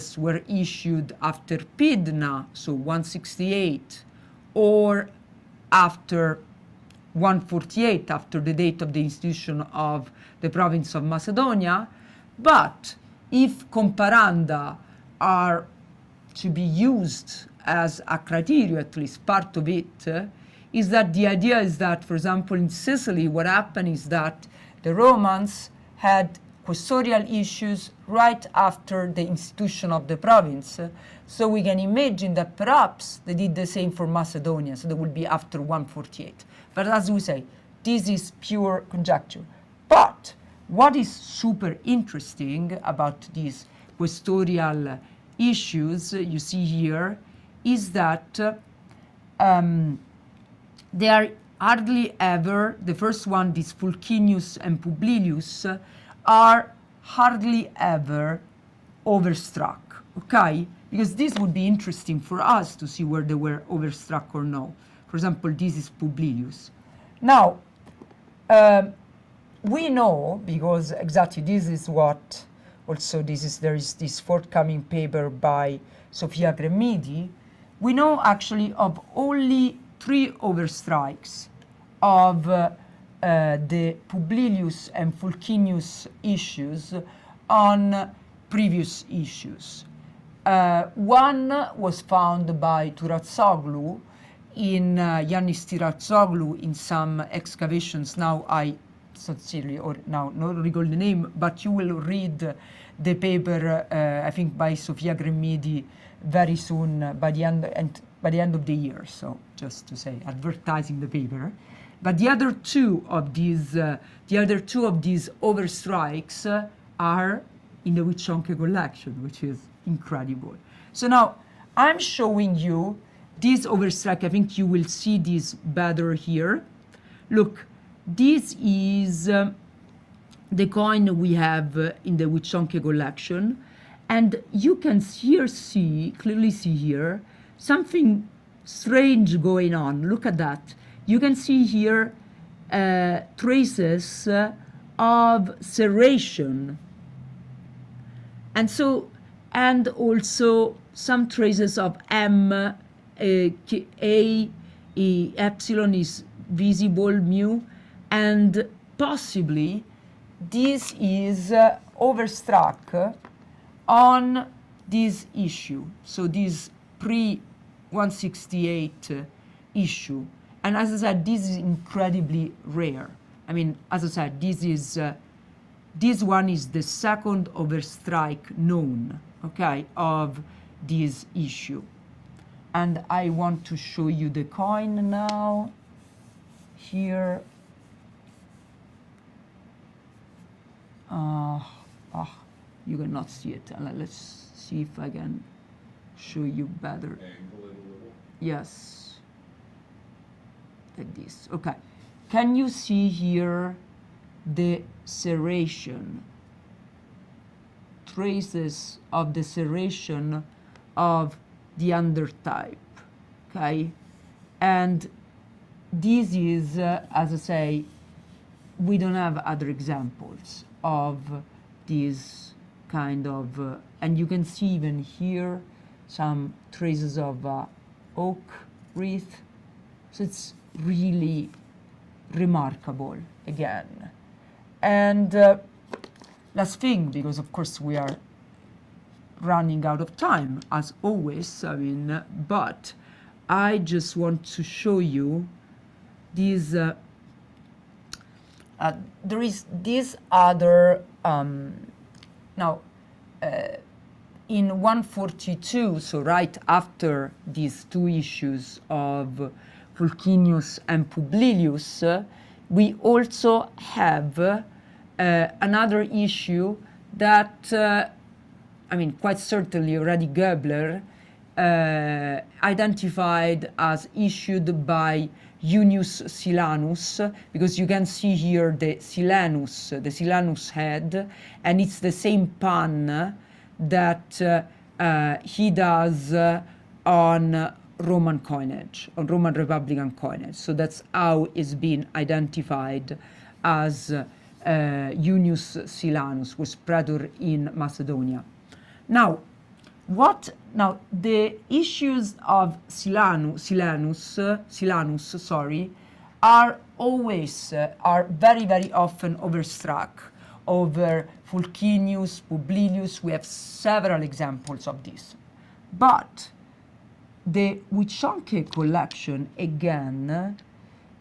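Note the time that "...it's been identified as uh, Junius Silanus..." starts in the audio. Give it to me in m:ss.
4:51.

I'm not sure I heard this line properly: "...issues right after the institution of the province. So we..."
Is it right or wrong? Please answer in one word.
right.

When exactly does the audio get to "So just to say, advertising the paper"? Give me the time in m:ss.
1:49.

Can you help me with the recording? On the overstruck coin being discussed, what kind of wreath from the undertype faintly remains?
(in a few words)
Oak wreath.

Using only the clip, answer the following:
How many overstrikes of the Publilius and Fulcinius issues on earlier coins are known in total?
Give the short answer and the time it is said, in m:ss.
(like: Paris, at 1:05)
3, at 1:20.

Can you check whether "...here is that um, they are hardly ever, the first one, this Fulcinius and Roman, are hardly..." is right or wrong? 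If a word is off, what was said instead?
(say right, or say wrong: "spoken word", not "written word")
wrong: "Publilius", not "Roman".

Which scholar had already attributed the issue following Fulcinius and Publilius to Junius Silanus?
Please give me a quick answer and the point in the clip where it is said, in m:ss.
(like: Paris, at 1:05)
Gaebler, at 4:30.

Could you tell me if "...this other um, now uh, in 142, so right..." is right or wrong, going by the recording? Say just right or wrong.
right.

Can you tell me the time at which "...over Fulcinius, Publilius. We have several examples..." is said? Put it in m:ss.
5:10.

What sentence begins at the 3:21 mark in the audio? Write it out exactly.
Okay, can you see here the serration, traces of the serration of the undertype, okay?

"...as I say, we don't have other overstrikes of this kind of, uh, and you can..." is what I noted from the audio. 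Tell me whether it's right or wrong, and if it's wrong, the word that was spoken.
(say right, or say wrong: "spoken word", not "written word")
wrong: "examples", not "overstrikes".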